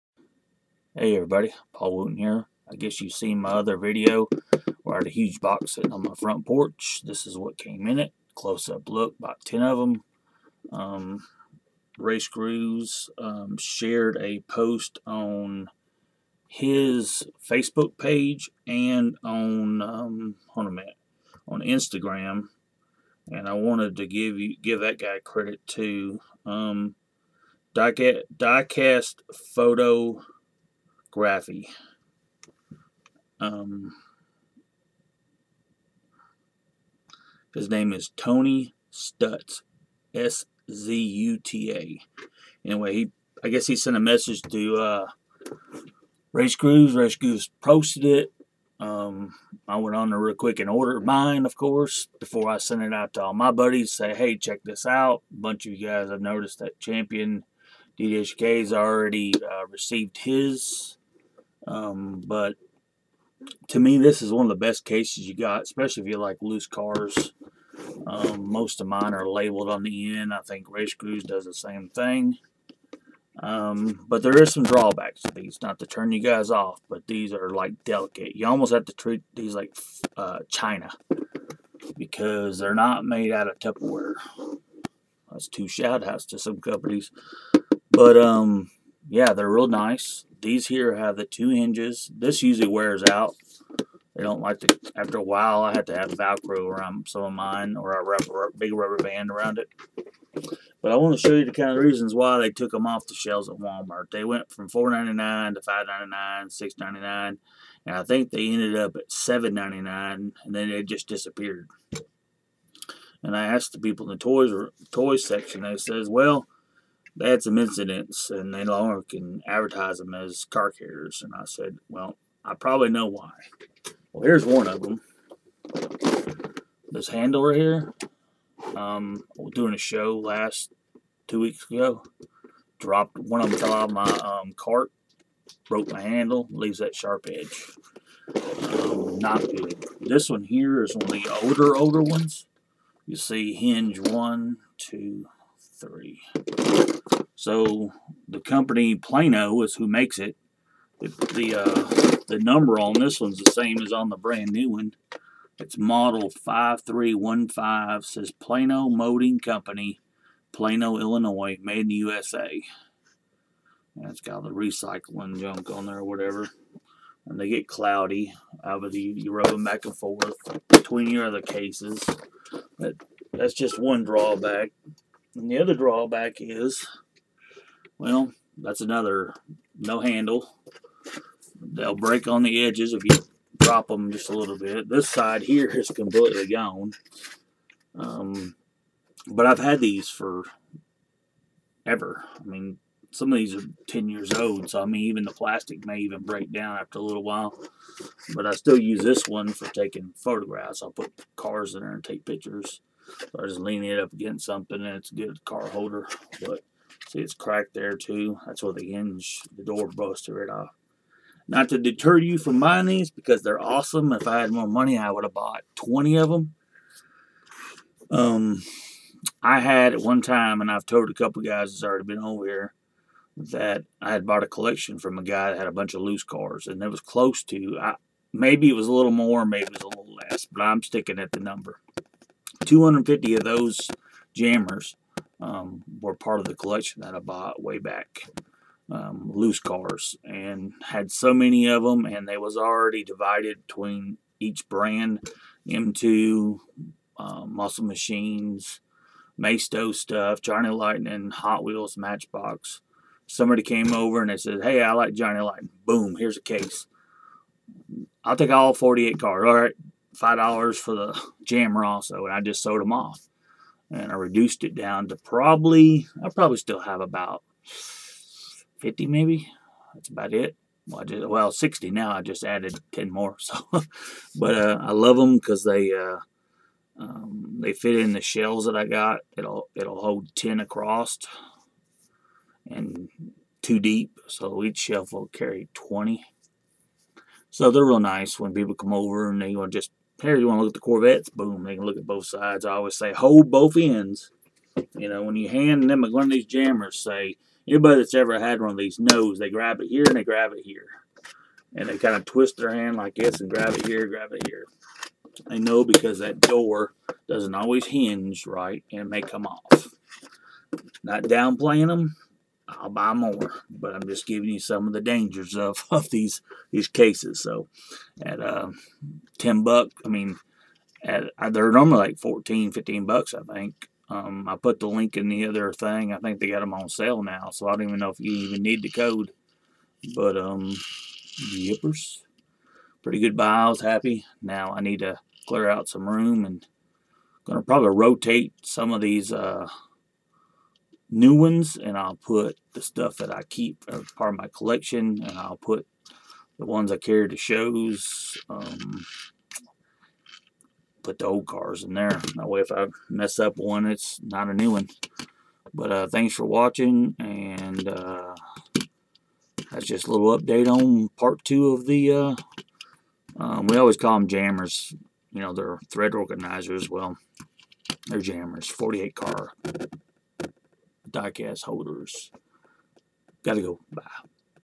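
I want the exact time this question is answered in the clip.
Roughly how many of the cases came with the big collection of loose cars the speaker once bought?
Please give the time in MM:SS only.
03:52.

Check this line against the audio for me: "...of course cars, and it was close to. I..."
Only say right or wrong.
wrong.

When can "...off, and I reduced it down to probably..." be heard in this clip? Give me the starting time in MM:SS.
04:22.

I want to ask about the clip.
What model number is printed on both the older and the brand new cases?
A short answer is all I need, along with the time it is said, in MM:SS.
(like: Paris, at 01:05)
5315, at 02:35.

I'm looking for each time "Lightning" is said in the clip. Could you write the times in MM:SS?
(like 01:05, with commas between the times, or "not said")
04:10, 04:15.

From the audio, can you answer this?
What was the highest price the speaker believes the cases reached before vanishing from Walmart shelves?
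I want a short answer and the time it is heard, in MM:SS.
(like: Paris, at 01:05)
$7.99, at 01:49.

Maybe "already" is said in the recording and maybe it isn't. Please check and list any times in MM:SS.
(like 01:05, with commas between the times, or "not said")
00:58, 03:41, 04:02.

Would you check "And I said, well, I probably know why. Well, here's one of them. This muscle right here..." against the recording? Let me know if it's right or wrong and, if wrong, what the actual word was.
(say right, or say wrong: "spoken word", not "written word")
wrong: "handle", not "muscle".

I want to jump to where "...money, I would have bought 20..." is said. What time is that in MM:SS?
03:34.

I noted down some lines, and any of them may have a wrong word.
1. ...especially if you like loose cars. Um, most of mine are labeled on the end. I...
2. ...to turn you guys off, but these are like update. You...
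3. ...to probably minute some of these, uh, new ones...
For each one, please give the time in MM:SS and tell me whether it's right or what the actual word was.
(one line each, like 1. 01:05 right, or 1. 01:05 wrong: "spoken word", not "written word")
1. 01:05 right
2. 01:15 wrong: "delicate", not "update"
3. 05:37 wrong: "rotate", not "minute".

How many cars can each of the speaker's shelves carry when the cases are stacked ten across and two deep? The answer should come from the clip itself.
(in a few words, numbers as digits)
20.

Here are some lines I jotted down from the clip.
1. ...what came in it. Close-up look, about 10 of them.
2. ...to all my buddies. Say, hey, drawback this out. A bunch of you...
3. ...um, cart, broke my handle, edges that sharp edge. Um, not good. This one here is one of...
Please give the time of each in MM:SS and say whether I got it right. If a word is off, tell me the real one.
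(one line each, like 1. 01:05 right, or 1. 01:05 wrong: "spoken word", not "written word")
1. 00:07 right
2. 00:53 wrong: "check", not "drawback"
3. 02:14 wrong: "leaves", not "edges".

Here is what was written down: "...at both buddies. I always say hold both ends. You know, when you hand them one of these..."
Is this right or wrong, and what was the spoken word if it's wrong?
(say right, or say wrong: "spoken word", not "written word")
wrong: "sides", not "buddies".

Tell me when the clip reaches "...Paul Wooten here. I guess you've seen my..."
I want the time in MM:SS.
00:01.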